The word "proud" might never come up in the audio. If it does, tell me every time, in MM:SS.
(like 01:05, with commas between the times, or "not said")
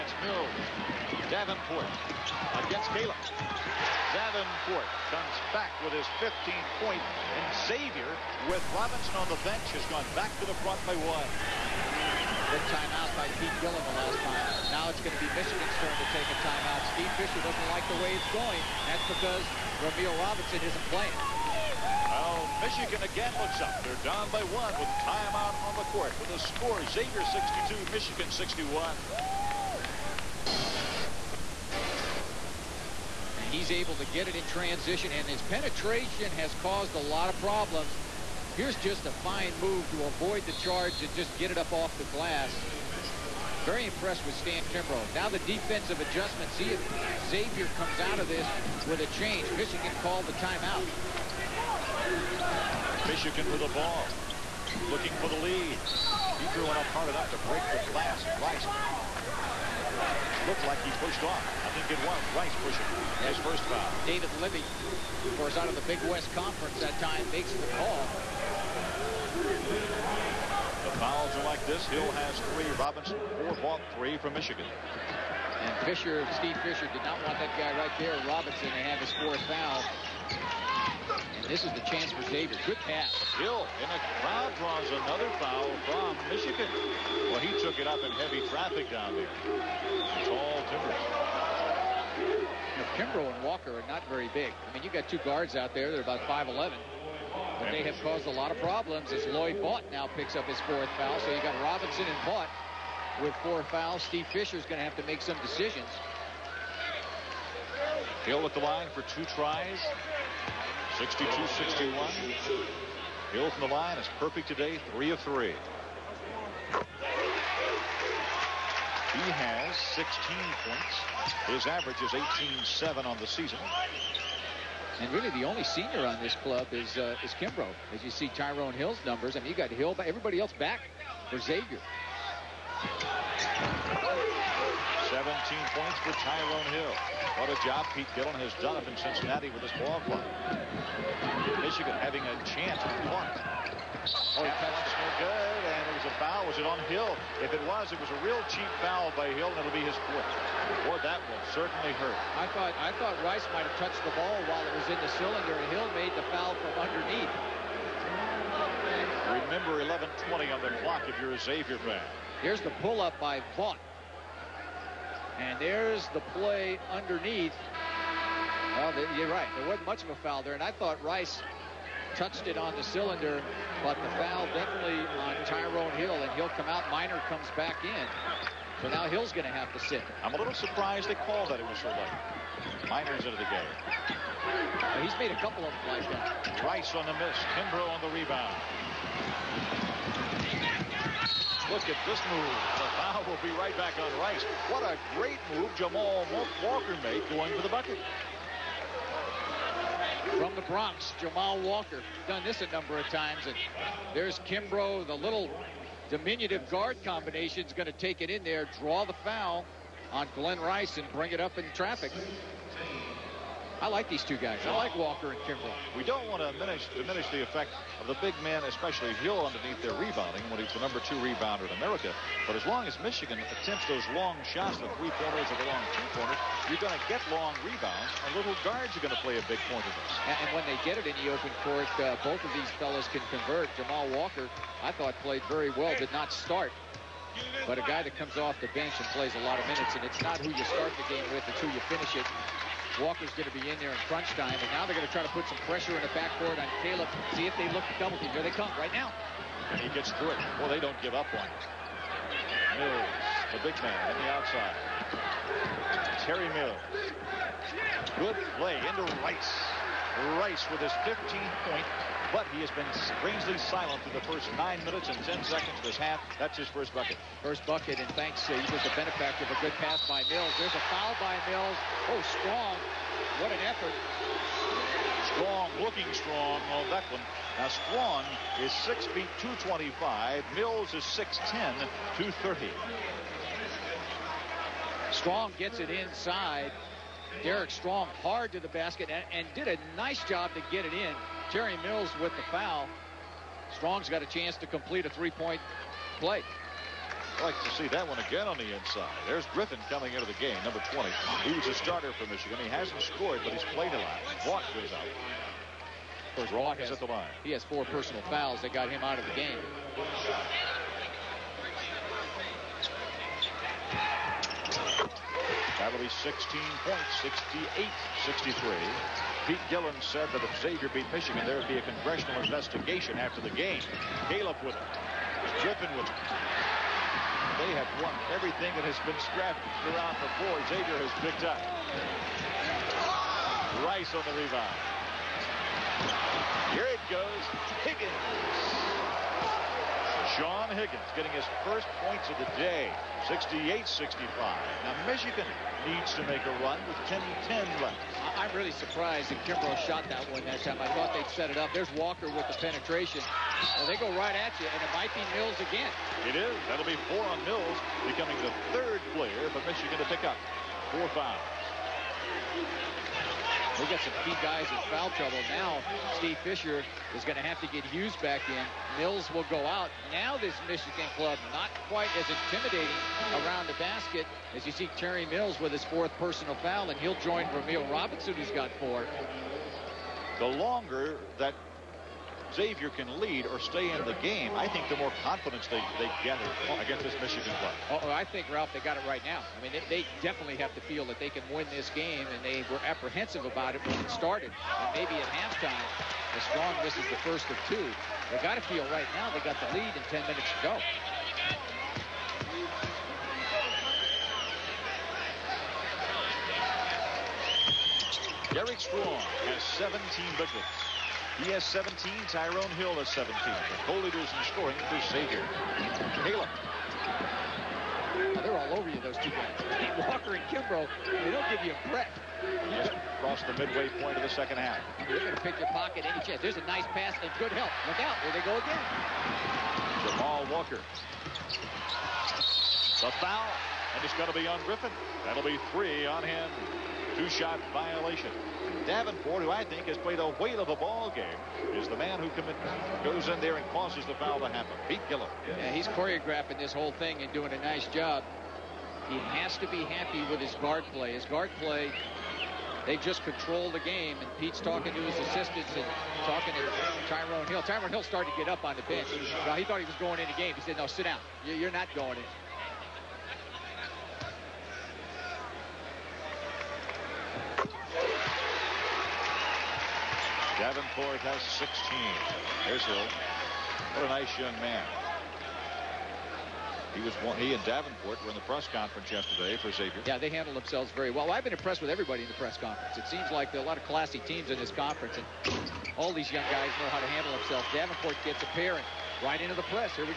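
not said.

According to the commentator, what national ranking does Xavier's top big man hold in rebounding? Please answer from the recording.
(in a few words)
Number two.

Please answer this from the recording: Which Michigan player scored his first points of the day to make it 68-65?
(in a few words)
Sean Higgins.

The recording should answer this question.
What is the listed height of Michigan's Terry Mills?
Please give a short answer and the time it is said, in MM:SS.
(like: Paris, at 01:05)
6'10", at 04:41.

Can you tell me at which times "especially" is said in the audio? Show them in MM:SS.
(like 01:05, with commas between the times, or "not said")
03:38.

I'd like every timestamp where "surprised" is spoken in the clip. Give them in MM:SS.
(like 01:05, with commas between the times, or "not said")
03:00, 05:48.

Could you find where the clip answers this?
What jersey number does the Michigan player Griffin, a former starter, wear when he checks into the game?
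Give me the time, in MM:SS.
05:00.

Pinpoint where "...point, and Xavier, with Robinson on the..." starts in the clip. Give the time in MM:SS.
00:06.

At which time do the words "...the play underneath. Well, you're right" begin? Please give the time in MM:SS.
02:46.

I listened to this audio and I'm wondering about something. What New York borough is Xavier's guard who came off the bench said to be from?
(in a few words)
The Bronx.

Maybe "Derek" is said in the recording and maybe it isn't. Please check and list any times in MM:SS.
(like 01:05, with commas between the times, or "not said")
04:47, 06:48.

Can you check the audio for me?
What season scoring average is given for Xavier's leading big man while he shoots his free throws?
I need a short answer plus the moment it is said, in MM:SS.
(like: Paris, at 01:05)
18.7, at 02:02.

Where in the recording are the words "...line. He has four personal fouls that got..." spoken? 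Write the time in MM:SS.
05:07.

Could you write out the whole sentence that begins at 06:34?
And maybe at halftime, the strong misses the first of two.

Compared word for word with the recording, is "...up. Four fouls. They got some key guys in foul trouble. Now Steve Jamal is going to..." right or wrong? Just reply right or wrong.
wrong.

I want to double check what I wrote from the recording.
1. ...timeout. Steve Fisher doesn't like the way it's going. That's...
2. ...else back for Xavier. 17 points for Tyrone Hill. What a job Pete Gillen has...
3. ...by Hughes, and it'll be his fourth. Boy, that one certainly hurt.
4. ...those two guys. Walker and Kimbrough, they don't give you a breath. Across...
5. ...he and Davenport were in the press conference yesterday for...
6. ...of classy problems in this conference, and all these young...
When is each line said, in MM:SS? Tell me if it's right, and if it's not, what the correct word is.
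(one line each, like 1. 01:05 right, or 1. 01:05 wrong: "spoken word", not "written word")
1. 00:16 right
2. 02:10 right
3. 02:29 wrong: "Hill", not "Hughes"
4. 06:59 right
5. 07:57 right
6. 08:03 wrong: "teams", not "problems".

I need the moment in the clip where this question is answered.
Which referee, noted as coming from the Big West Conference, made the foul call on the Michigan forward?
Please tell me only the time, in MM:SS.
01:04.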